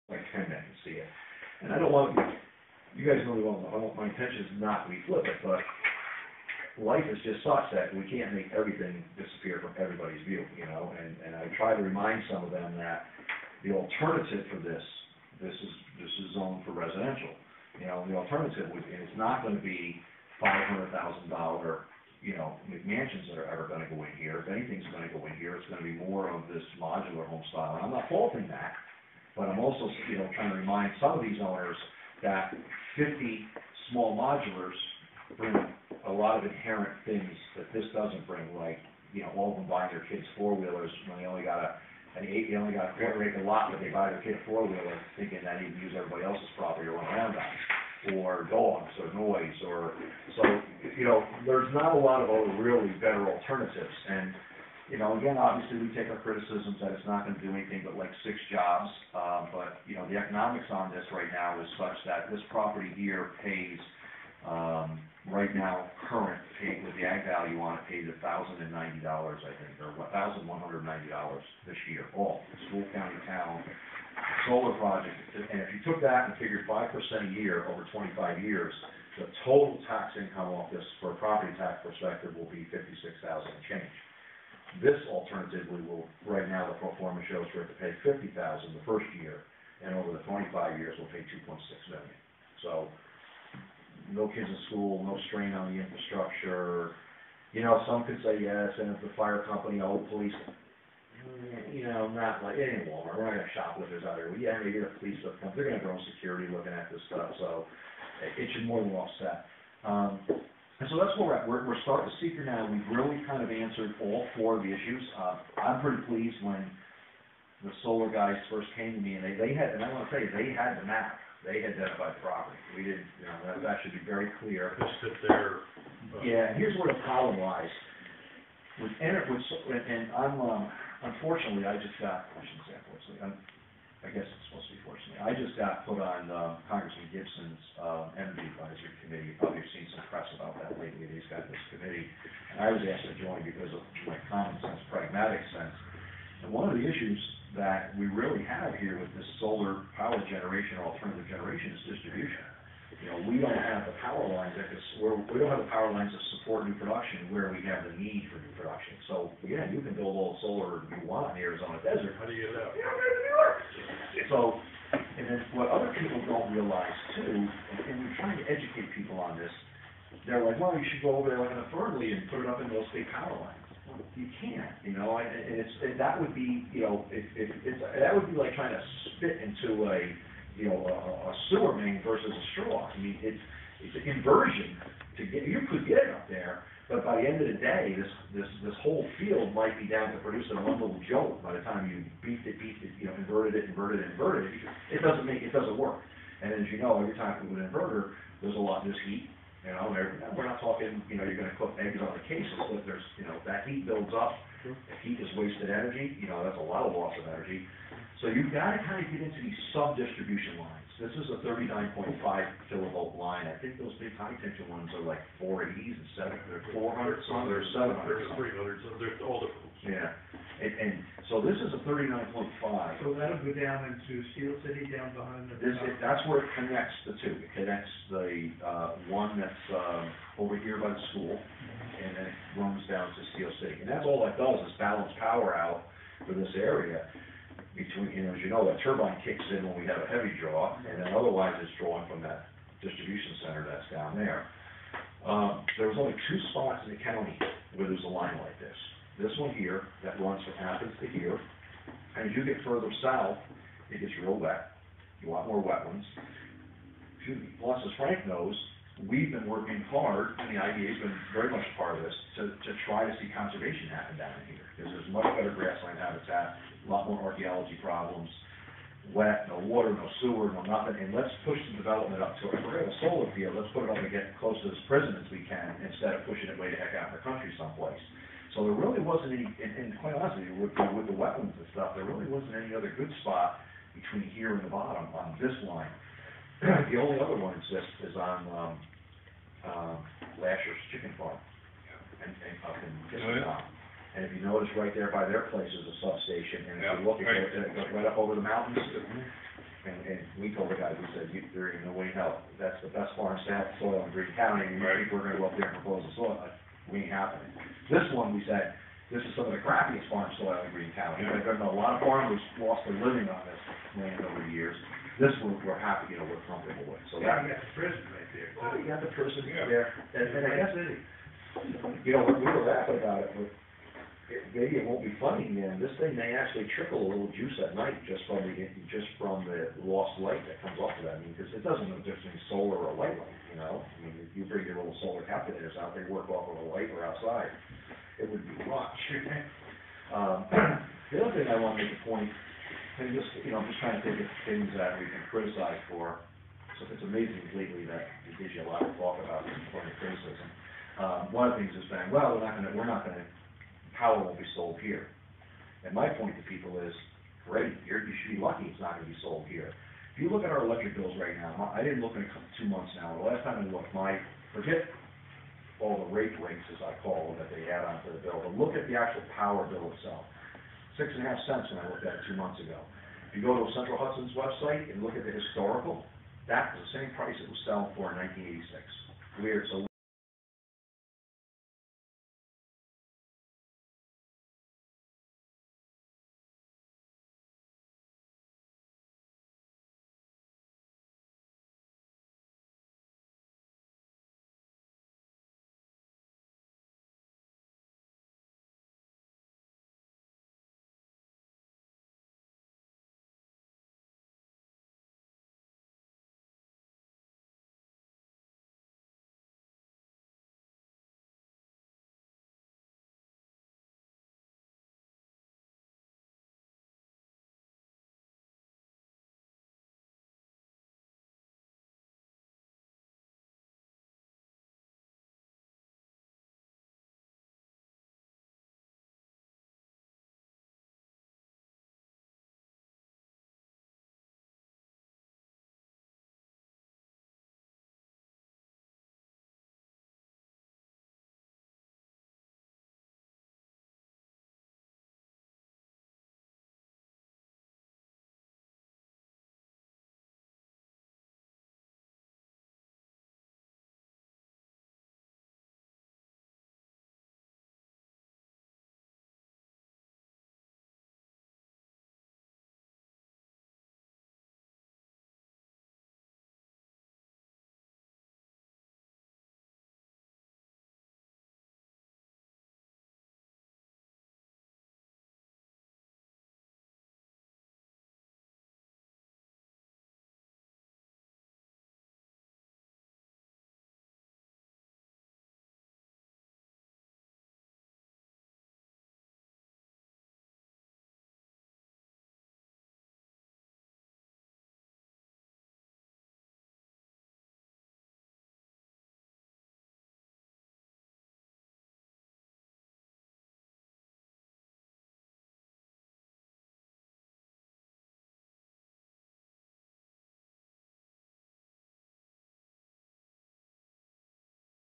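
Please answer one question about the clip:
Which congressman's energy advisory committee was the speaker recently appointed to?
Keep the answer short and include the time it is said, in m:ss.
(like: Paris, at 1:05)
Gibson, at 2:17.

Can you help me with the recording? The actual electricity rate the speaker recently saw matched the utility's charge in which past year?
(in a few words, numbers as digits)
1986.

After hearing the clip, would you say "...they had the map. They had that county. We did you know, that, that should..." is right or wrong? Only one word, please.
wrong.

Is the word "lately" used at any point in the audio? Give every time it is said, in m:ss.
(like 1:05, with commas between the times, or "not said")
2:20, 5:47.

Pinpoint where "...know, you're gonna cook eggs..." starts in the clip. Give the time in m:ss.
3:21.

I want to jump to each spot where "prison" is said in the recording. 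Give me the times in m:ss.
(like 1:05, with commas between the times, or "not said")
4:34, 5:17.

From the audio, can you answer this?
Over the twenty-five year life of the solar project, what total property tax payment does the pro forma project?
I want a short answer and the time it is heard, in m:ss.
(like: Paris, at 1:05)
2.6 million, at 1:31.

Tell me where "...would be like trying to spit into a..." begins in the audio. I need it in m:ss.
2:58.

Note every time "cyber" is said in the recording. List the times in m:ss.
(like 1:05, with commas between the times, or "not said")
not said.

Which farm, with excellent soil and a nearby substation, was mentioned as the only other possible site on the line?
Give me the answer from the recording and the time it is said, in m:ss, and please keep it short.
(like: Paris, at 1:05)
Lasher's Chicken Farm, at 4:50.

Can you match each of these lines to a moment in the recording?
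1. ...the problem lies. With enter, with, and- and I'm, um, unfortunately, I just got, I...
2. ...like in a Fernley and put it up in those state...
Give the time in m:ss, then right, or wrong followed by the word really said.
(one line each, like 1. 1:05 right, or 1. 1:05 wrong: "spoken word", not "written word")
1. 2:06 right
2. 2:51 right.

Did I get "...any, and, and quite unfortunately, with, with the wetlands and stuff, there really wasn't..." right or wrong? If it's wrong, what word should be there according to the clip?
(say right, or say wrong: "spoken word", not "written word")
wrong: "honestly", not "unfortunately".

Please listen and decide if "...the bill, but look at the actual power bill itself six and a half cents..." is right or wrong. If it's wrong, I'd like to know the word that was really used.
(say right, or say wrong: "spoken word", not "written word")
right.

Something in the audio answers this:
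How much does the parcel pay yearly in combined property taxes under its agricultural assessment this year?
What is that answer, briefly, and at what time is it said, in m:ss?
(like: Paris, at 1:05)
$1,190, at 1:09.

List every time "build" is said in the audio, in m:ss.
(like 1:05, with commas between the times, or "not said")
2:39, 3:23.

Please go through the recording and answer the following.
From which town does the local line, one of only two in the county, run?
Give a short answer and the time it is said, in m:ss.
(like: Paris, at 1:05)
Athens, at 4:10.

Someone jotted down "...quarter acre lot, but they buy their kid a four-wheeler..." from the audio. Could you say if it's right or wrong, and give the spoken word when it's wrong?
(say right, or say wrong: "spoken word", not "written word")
right.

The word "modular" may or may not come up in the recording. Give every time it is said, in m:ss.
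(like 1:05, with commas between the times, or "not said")
0:26, 0:34.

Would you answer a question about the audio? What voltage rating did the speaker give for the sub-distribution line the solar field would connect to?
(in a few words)
39.5 kilovolt.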